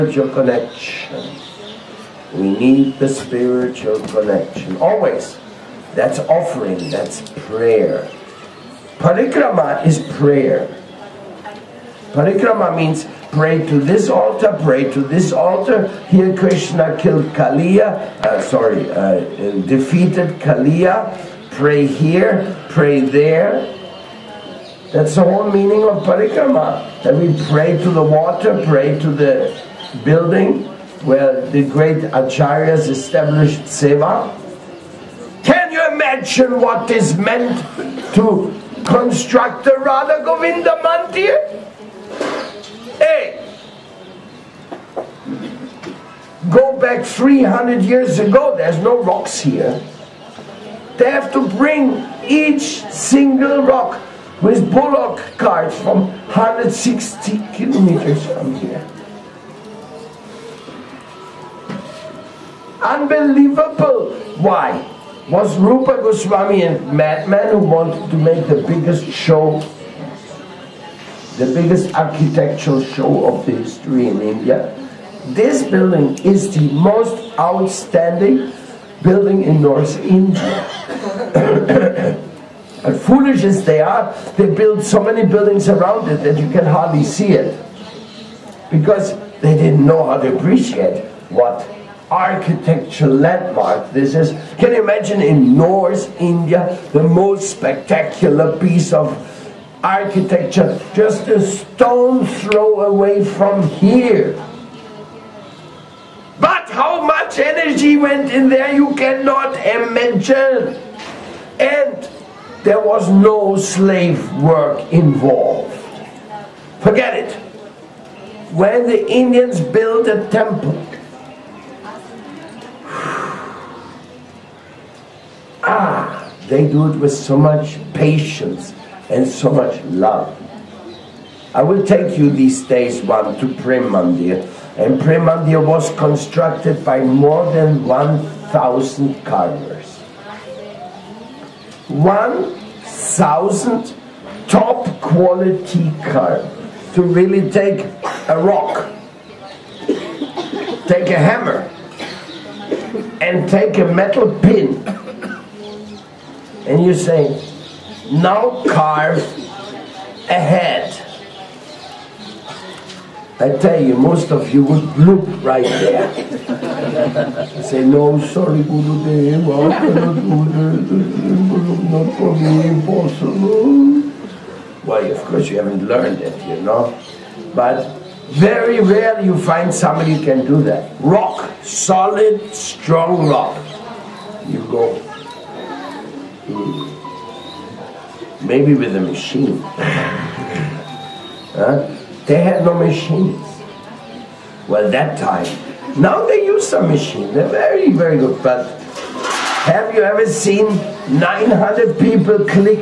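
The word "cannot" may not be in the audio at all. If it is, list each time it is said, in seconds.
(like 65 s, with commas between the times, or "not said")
108 s, 169 s.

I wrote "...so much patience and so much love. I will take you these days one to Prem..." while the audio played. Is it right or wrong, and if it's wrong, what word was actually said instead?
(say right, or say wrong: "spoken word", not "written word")
right.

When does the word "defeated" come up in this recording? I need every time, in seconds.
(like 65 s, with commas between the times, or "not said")
19 s.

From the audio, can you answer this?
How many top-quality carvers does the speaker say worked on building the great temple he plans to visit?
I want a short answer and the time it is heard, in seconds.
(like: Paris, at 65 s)
more than 1,000, at 136 s.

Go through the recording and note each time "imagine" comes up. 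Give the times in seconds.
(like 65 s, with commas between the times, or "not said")
94 s, 109 s.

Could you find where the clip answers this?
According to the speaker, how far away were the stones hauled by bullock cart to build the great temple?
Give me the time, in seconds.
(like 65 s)
56 s.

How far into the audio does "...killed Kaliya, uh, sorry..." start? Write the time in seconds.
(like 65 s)
16 s.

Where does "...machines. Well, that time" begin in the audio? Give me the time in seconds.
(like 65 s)
192 s.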